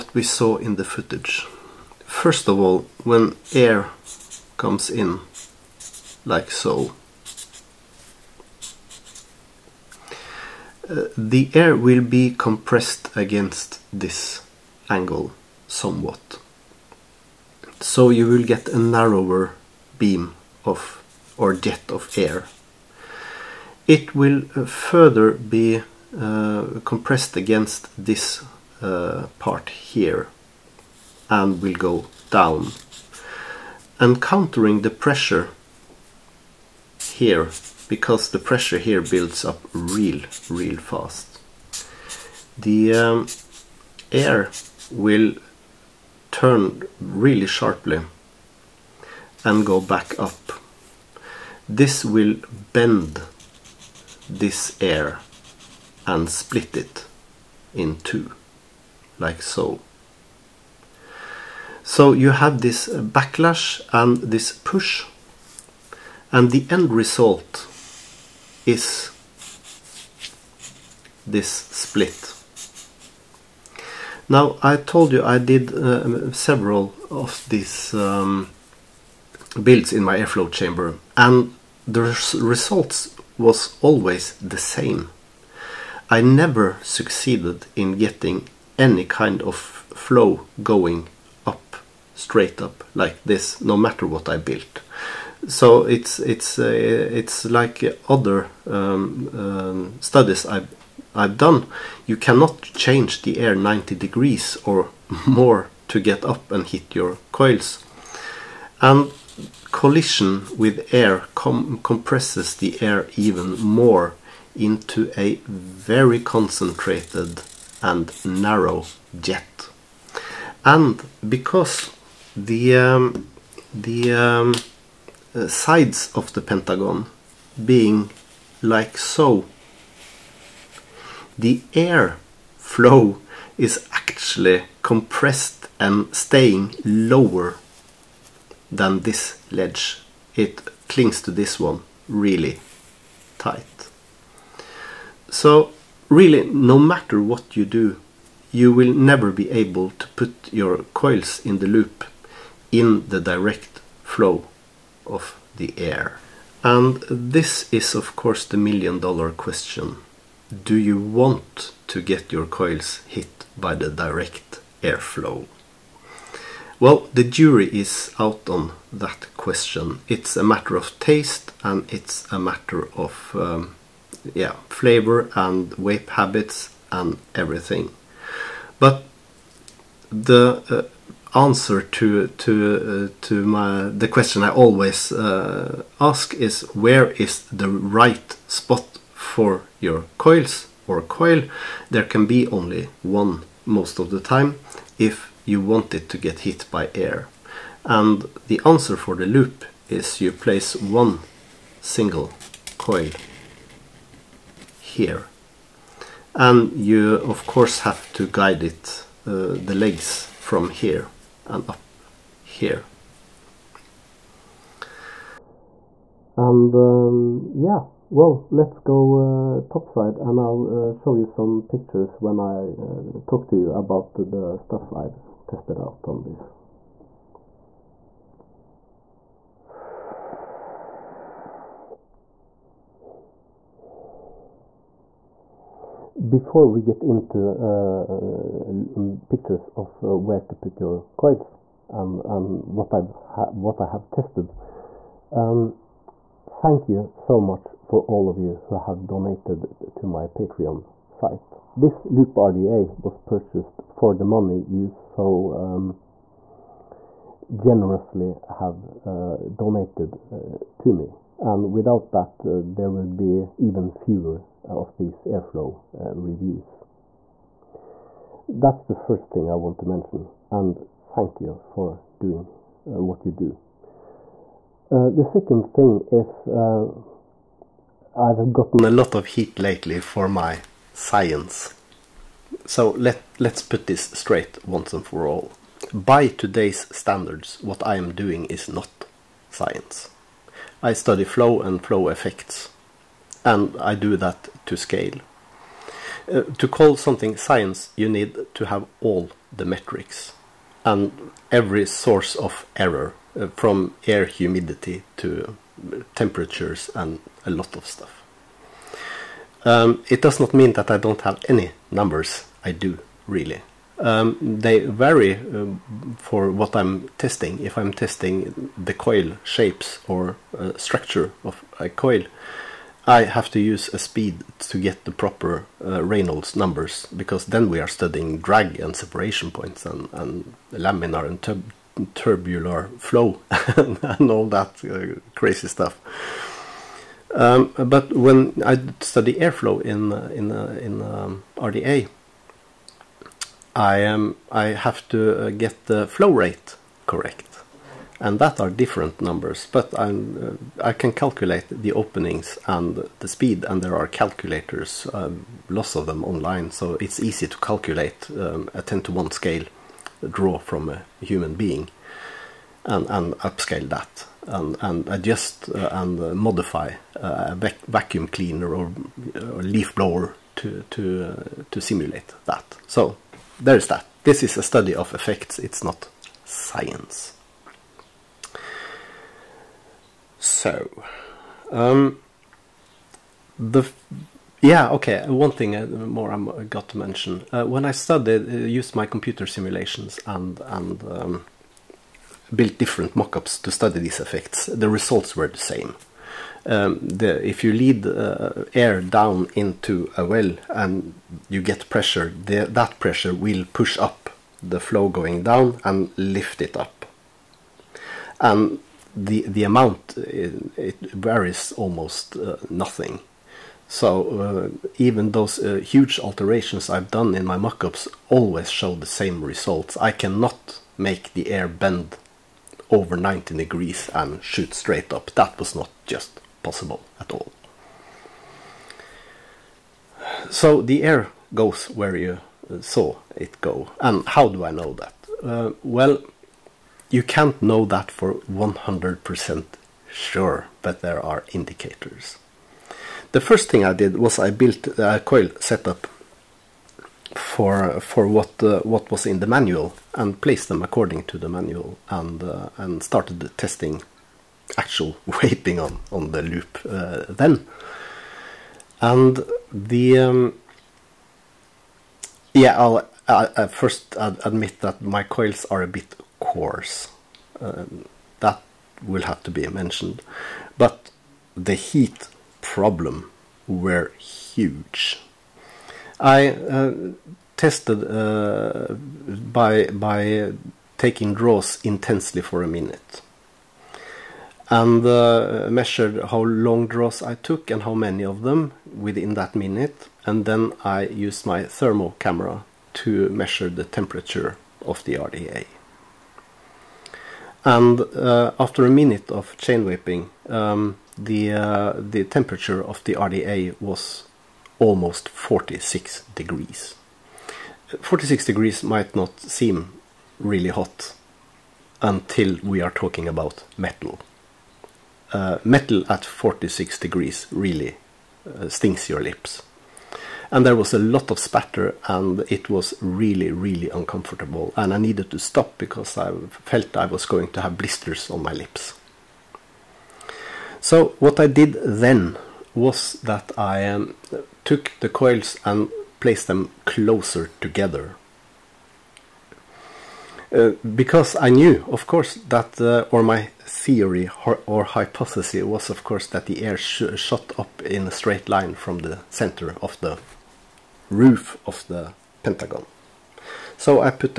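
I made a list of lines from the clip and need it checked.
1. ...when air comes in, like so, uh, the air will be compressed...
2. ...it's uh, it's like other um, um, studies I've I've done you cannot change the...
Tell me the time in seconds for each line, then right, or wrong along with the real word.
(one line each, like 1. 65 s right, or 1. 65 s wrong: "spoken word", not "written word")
1. 3 s right
2. 96 s right.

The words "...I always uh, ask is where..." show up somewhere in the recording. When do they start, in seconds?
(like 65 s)
184 s.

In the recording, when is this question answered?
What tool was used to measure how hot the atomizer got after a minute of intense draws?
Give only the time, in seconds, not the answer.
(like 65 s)
491 s.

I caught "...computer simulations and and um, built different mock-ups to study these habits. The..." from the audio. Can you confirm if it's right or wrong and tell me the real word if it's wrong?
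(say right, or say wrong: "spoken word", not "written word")
wrong: "effects", not "habits".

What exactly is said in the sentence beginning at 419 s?
I cannot make the air bend over 90 degrees and shoot straight up.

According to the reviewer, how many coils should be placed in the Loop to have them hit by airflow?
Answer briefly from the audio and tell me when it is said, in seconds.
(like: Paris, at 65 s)
One single coil, at 200 s.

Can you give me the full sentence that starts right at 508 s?
46 degrees might not seem really hot until we are talking about metal.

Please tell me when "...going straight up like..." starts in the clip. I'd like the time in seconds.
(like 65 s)
90 s.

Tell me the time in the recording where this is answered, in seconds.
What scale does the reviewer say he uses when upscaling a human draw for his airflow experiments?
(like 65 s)
358 s.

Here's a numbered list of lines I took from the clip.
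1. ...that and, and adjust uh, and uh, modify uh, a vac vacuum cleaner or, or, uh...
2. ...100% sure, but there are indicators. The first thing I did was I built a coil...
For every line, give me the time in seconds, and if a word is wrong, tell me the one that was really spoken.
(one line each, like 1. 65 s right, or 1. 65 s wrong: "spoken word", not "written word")
1. 363 s right
2. 438 s right.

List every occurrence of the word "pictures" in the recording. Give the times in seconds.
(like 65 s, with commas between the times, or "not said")
221 s, 239 s.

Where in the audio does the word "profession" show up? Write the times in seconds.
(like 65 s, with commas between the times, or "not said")
not said.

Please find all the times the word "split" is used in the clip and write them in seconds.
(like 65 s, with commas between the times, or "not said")
56 s, 71 s.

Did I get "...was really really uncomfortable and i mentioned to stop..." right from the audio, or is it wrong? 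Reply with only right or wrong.
wrong.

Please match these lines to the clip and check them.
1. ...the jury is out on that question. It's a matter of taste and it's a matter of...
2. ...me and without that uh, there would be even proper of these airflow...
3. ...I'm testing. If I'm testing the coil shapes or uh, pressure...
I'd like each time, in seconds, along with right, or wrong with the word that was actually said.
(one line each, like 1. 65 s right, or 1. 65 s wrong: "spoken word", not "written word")
1. 167 s right
2. 260 s wrong: "fewer", not "proper"
3. 316 s wrong: "structure", not "pressure".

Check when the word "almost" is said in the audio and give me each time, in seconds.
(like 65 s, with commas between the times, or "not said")
411 s, 504 s.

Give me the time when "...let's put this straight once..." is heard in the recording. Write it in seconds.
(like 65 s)
283 s.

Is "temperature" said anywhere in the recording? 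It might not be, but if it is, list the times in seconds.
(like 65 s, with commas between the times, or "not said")
306 s, 493 s, 502 s.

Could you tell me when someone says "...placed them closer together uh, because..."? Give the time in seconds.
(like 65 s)
536 s.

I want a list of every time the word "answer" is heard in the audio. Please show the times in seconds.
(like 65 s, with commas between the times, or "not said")
181 s, 198 s.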